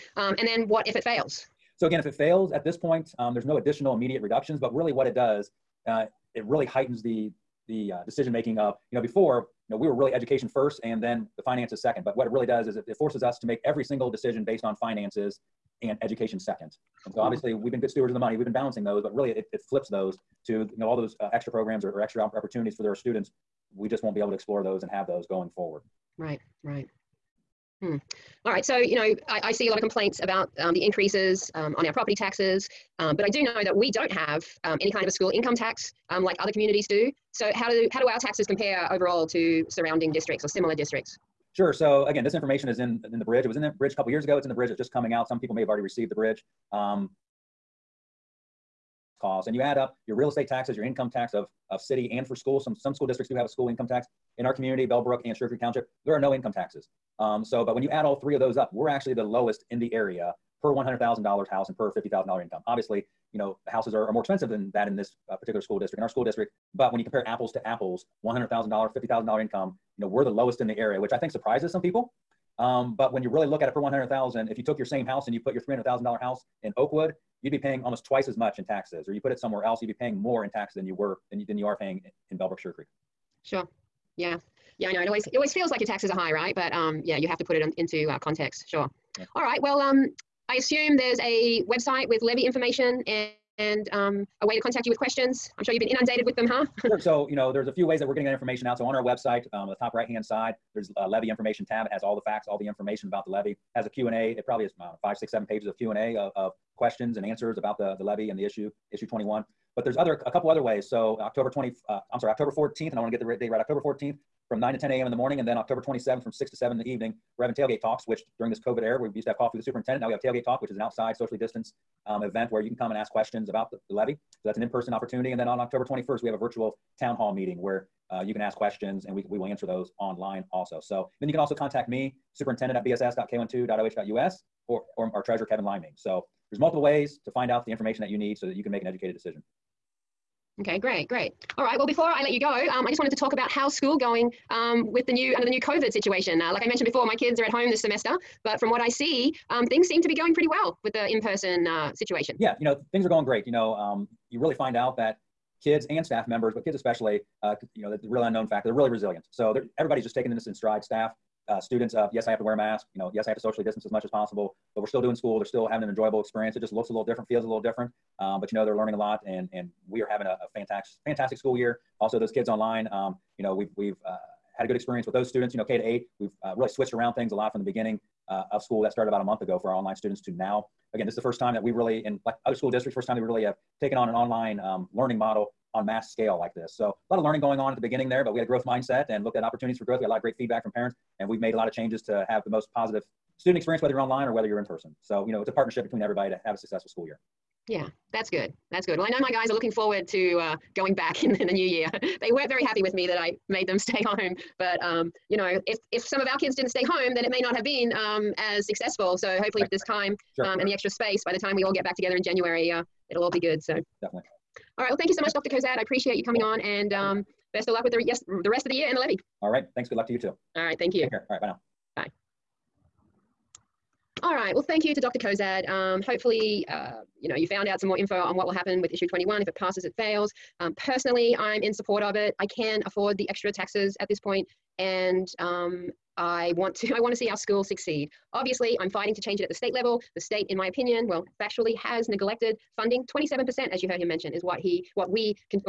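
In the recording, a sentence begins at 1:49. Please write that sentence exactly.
But there's other a couple other ways.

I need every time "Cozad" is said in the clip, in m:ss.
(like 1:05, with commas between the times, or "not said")
3:35, 3:45.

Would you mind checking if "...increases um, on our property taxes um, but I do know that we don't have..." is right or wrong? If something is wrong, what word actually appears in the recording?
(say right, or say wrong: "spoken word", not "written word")
right.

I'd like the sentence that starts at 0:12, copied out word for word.
But what it really does is it, it forces us to make every single decision based on finances and education second.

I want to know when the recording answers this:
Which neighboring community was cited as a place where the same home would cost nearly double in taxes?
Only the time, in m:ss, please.
1:16.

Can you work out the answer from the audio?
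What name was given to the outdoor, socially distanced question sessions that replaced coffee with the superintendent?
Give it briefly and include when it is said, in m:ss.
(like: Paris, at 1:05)
Tailgate Talks, at 1:57.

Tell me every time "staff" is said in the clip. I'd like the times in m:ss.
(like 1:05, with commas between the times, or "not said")
2:36, 2:40.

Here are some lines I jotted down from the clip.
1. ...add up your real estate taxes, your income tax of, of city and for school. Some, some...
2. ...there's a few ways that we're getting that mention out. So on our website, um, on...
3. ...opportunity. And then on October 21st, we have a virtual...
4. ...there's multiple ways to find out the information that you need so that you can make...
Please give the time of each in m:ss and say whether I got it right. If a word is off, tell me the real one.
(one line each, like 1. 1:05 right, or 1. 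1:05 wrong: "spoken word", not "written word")
1. 0:49 right
2. 1:37 wrong: "information", not "mention"
3. 2:04 right
4. 2:16 right.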